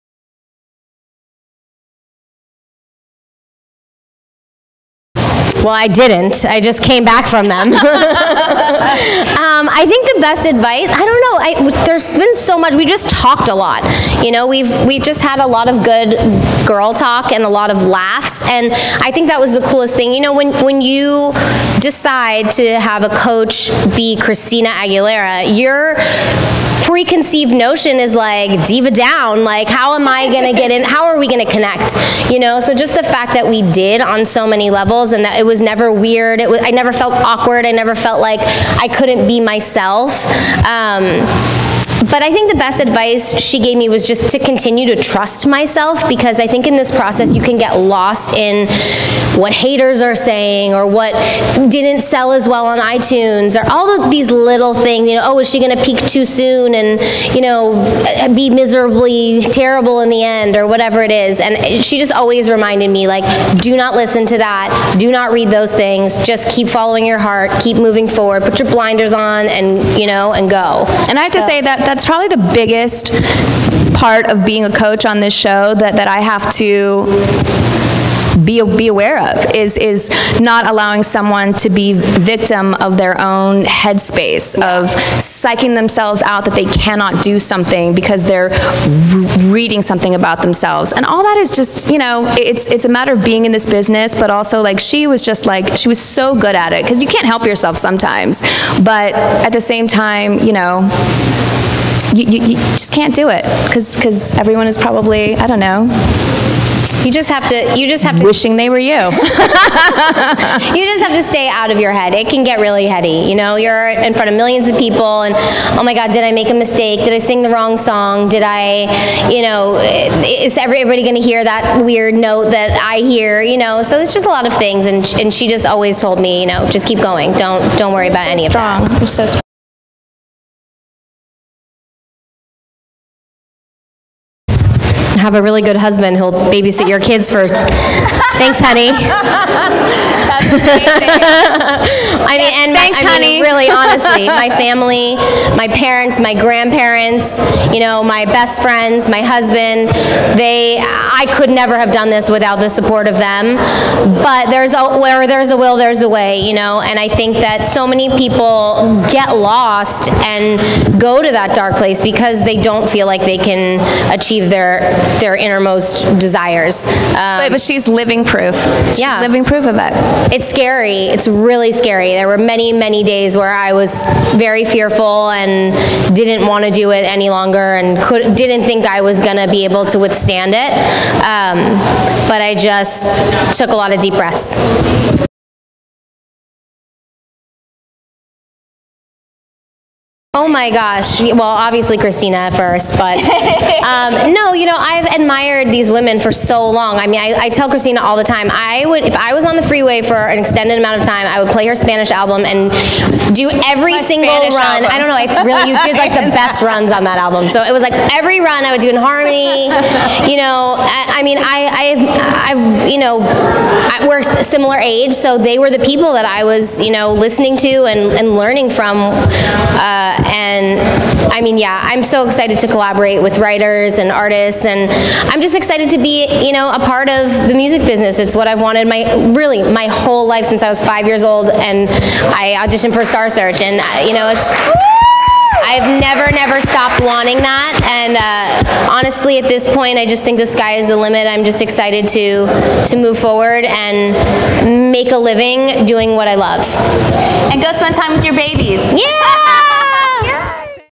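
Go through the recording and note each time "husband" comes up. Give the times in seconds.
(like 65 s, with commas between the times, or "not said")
135 s, 149 s.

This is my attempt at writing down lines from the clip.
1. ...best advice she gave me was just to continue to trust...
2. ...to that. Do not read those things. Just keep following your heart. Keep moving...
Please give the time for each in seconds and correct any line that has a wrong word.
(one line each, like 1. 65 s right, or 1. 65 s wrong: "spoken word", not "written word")
1. 42 s right
2. 64 s right.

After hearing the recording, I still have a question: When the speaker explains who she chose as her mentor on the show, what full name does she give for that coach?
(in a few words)
Christina Aguilera.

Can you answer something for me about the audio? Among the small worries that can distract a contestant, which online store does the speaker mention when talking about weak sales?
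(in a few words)
iTunes.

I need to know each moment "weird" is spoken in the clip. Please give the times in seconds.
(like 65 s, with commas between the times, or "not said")
35 s, 121 s.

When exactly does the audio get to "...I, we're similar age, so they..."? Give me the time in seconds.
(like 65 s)
213 s.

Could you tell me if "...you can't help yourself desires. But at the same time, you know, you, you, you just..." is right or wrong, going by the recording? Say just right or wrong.
wrong.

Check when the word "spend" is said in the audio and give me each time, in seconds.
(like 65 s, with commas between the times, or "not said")
247 s.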